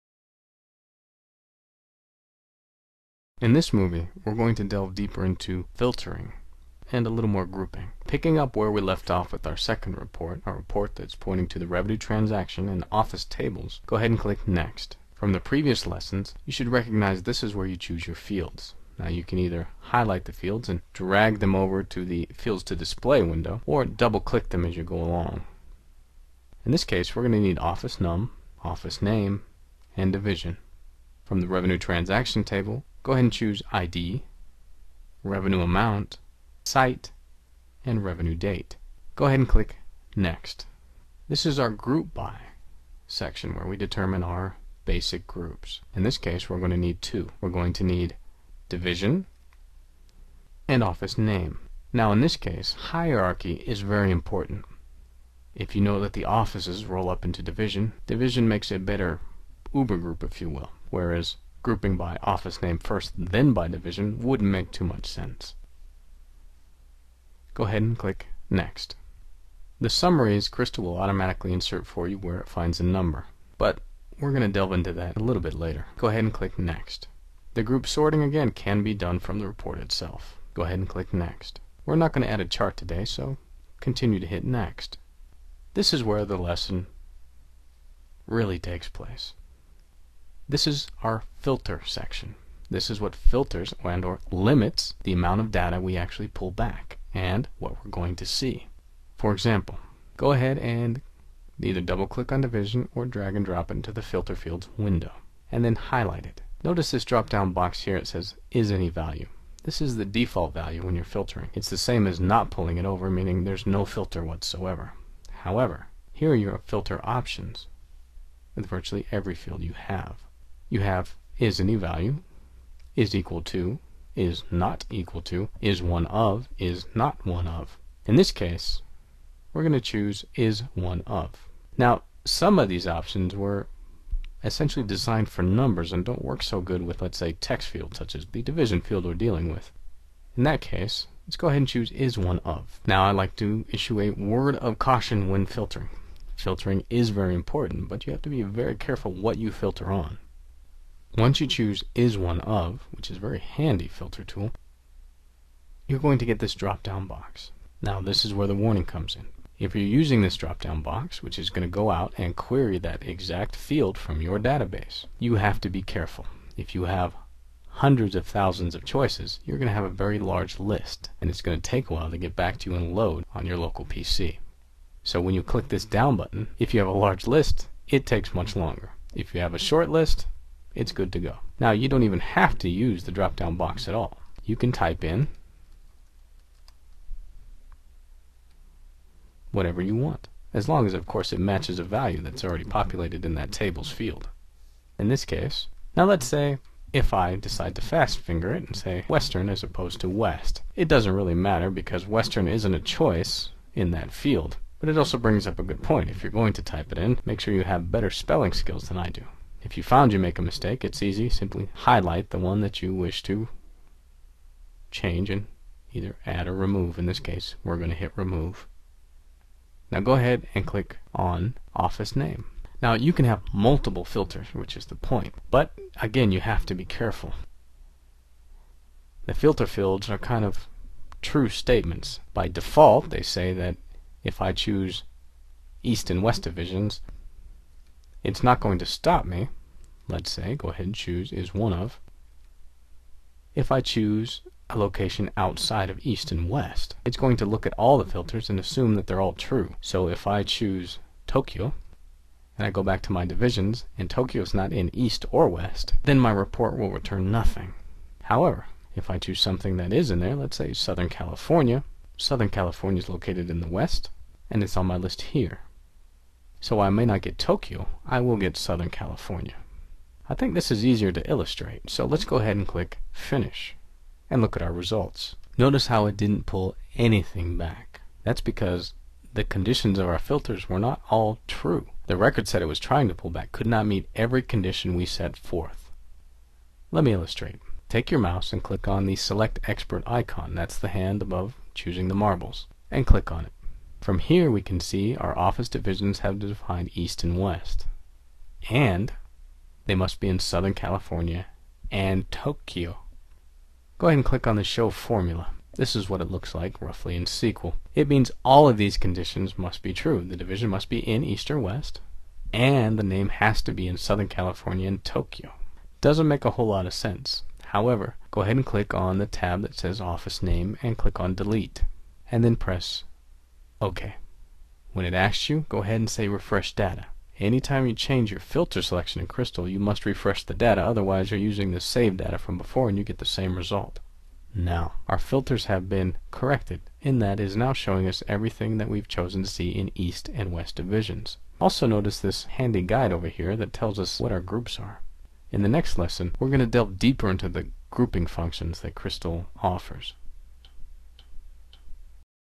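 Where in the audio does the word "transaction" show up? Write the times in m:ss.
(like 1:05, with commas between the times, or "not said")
0:11, 0:31.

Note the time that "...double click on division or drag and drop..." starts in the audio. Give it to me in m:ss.
1:41.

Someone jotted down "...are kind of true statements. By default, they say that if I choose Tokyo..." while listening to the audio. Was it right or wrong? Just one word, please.
wrong.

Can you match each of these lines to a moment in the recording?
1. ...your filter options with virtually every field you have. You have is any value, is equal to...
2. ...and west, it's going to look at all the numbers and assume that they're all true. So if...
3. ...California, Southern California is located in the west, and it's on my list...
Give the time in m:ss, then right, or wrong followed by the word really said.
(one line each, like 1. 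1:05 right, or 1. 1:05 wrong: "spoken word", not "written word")
1. 1:56 right
2. 4:06 wrong: "filters", not "numbers"
3. 4:21 right.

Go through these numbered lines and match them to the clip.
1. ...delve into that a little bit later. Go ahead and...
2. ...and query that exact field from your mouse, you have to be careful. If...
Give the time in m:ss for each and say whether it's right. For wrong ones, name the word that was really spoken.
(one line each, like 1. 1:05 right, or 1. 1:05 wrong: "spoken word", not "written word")
1. 1:14 right
2. 2:42 wrong: "database", not "mouse".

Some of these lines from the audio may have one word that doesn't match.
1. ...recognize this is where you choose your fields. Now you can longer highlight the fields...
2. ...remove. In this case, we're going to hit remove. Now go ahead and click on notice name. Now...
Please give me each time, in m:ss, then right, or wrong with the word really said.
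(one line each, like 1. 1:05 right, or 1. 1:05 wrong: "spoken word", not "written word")
1. 0:16 wrong: "either", not "longer"
2. 3:36 wrong: "office", not "notice".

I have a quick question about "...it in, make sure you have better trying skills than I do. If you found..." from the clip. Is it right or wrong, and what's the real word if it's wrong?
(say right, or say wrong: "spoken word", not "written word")
wrong: "spelling", not "trying".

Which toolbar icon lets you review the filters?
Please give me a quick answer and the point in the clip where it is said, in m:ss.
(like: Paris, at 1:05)
Select Expert, at 4:49.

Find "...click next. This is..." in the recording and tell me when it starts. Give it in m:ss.
0:39.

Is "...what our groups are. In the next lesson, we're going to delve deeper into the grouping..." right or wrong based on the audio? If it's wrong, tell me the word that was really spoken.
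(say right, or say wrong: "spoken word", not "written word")
right.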